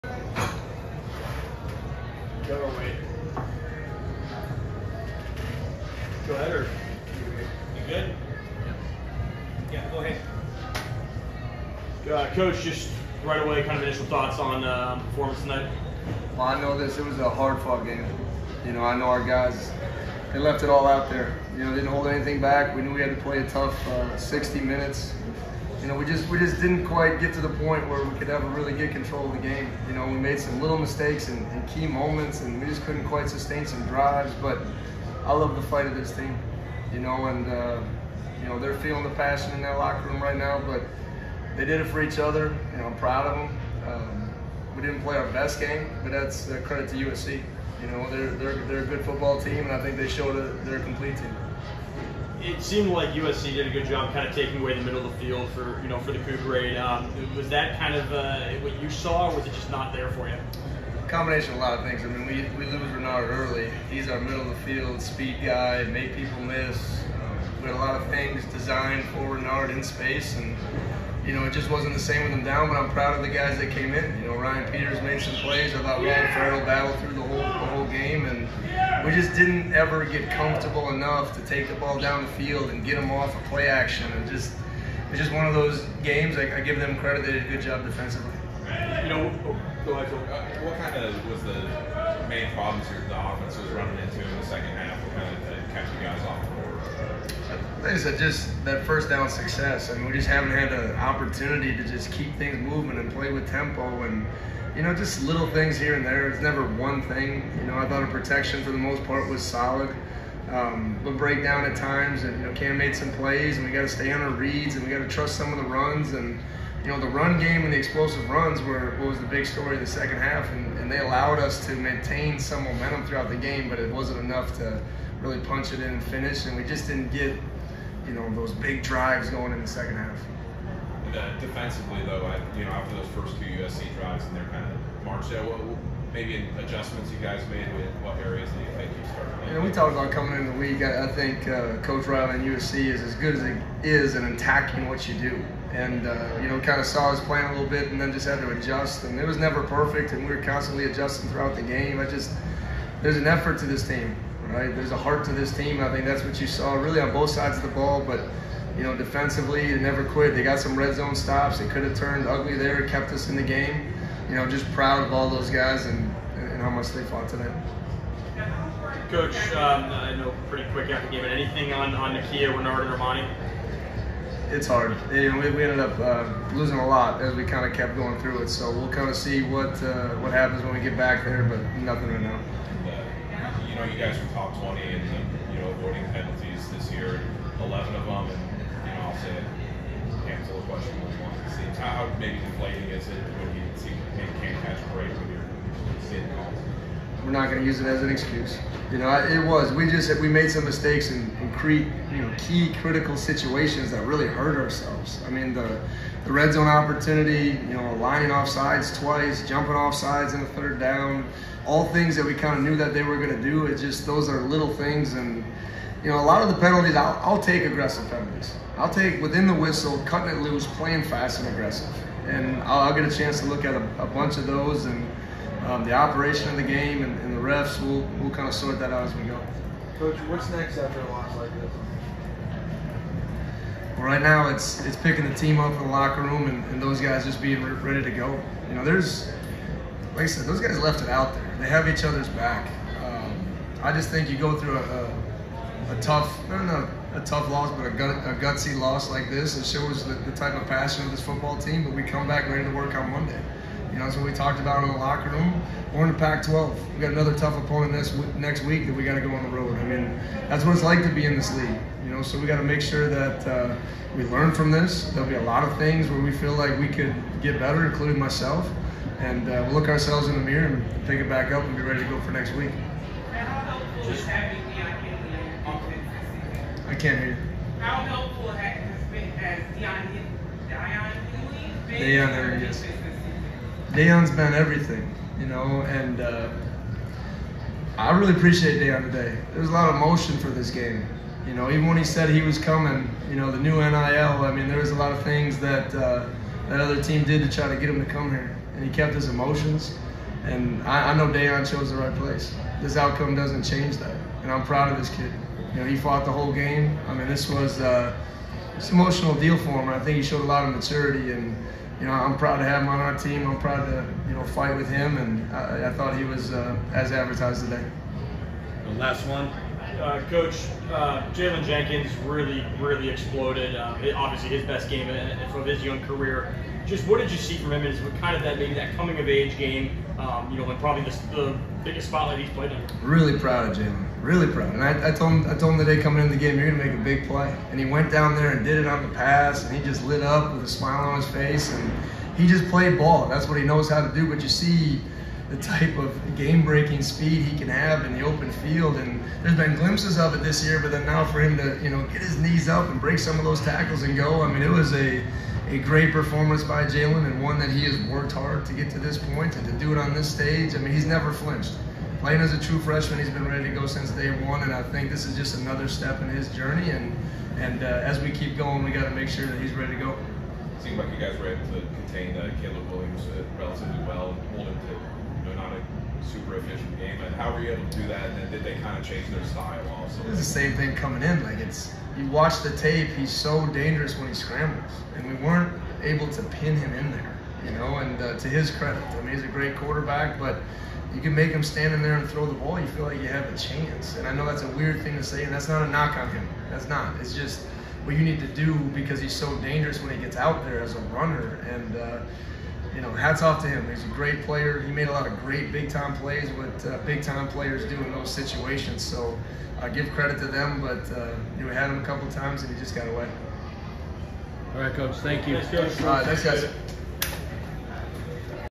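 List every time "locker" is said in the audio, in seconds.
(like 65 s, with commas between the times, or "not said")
39 s, 235 s, 254 s.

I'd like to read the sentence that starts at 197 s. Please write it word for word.
We're not going to use it as an excuse.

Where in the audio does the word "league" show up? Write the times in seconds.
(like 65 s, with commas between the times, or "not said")
140 s, 261 s.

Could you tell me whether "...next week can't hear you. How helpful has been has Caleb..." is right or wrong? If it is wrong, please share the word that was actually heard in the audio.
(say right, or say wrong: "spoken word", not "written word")
wrong: "Daiyan", not "Caleb".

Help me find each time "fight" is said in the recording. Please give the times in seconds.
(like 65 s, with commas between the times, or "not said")
35 s, 314 s.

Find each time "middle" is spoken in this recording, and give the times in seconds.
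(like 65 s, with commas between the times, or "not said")
54 s, 64 s.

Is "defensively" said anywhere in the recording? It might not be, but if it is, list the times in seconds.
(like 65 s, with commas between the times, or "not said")
87 s, 131 s, 158 s.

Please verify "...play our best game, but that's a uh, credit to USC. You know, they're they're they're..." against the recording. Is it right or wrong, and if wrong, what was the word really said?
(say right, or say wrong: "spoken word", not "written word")
right.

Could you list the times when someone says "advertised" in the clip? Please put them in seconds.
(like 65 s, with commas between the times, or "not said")
317 s.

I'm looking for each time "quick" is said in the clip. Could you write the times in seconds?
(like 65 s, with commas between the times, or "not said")
170 s.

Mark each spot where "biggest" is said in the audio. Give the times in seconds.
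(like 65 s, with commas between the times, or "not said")
331 s.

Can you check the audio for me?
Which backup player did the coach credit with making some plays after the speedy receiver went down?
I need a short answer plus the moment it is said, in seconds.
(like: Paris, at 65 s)
Orion Peters, at 74 s.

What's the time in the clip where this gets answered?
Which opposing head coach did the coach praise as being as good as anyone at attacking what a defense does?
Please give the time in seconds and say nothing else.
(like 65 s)
141 s.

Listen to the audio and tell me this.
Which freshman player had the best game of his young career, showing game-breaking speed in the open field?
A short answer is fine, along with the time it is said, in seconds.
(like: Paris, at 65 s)
Jaylen Jenkins, at 321 s.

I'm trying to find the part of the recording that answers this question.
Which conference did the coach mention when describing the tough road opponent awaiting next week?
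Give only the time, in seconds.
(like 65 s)
256 s.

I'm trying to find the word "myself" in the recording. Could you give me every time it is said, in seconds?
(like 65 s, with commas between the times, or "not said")
268 s.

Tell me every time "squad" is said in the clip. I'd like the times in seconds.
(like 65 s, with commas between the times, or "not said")
not said.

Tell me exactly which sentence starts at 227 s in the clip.
We'll, we'll kind of sort that out as we go.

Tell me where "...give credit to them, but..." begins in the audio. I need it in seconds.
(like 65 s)
409 s.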